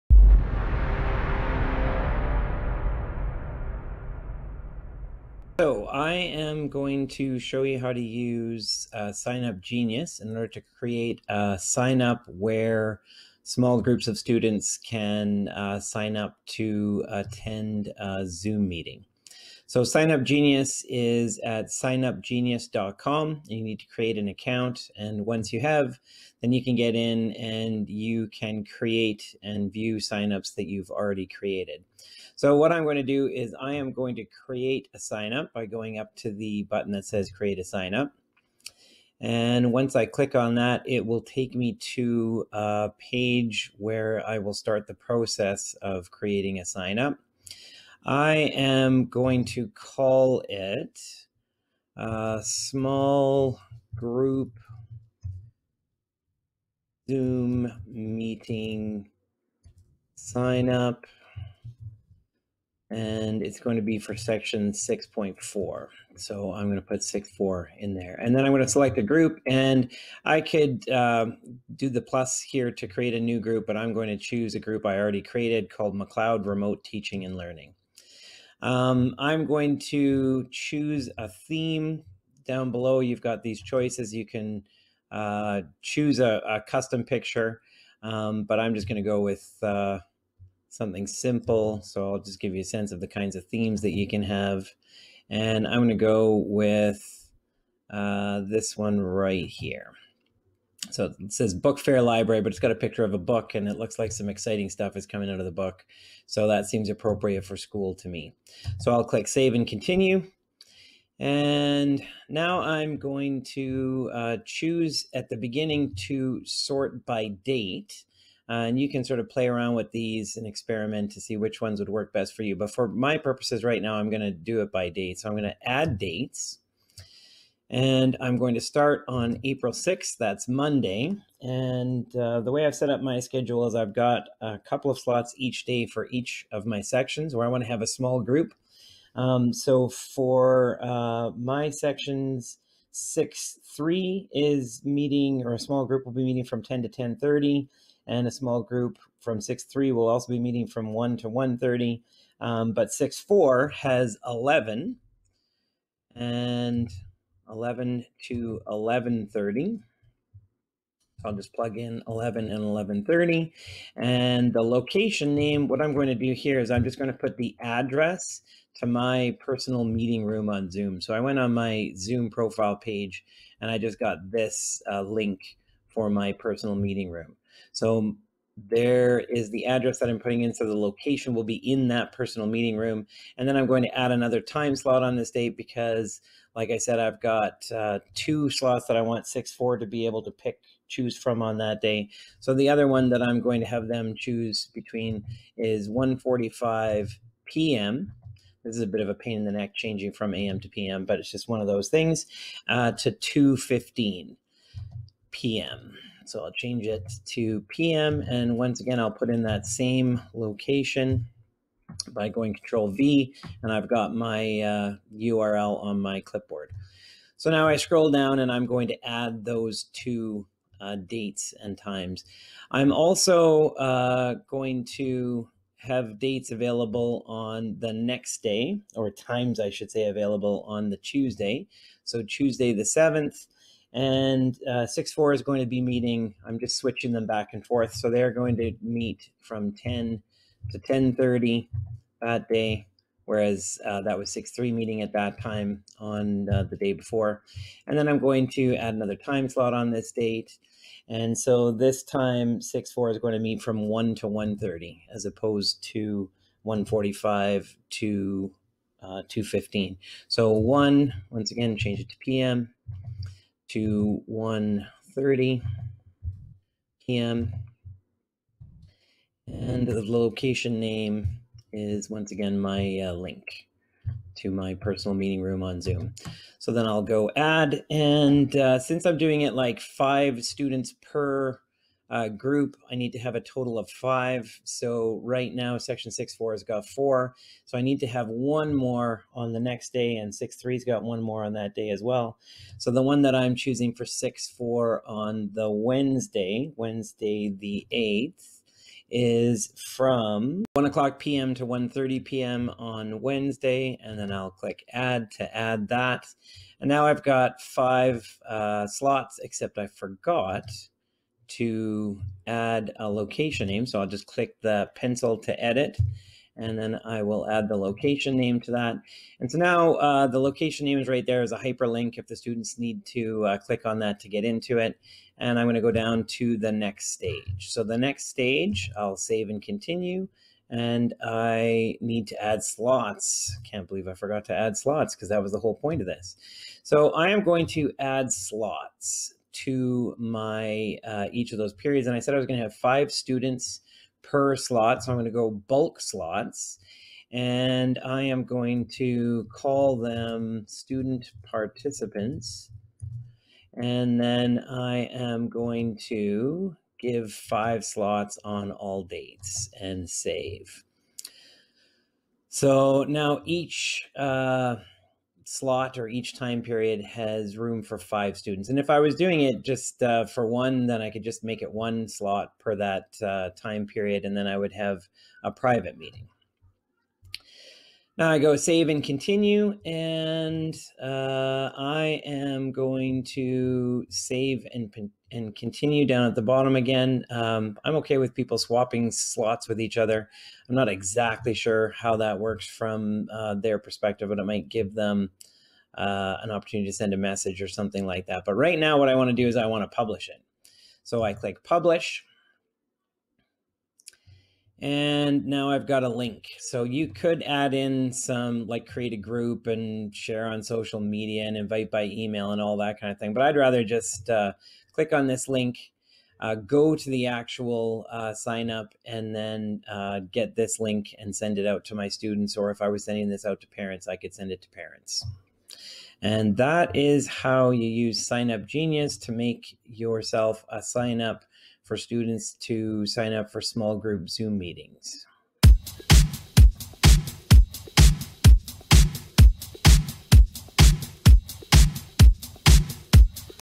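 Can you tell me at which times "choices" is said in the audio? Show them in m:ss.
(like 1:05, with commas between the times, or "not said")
1:23.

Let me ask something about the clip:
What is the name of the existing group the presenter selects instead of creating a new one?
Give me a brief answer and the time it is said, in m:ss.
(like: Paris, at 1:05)
McLeod Remote Teaching and Learning, at 1:15.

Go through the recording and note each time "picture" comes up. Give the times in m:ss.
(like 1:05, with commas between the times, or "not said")
1:27, 1:42.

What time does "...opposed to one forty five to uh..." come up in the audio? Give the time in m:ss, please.
4:15.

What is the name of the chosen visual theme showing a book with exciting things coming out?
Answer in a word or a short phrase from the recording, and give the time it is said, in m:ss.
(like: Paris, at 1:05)
Book Fair Library, at 1:41.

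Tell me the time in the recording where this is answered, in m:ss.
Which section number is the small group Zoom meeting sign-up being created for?
1:03.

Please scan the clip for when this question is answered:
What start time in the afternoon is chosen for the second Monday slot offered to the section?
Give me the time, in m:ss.
3:15.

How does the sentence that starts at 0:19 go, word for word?
So SignUp Genius is at signupgenius.com.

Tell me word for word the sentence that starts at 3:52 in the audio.
So Tuesday the 7th, and uh, six four is going to be meeting.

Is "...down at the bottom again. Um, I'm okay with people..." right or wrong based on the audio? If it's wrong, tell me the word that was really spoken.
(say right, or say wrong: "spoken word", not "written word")
right.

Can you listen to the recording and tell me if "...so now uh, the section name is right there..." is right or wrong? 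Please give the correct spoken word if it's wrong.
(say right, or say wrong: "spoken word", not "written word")
wrong: "location", not "section".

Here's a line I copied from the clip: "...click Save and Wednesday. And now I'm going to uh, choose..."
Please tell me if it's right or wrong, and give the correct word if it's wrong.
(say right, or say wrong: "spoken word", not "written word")
wrong: "Continue", not "Wednesday".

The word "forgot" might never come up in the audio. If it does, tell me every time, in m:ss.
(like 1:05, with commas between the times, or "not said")
5:09, 5:34.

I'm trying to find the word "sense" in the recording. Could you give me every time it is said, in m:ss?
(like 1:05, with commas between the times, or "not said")
1:32.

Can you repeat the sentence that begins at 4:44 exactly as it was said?
So right now, section six four has got four.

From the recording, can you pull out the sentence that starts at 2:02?
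But for my purposes right now, I'm going to do it by date.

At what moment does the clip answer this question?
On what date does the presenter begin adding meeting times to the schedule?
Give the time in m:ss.
2:09.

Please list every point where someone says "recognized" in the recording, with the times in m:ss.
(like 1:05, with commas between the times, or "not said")
not said.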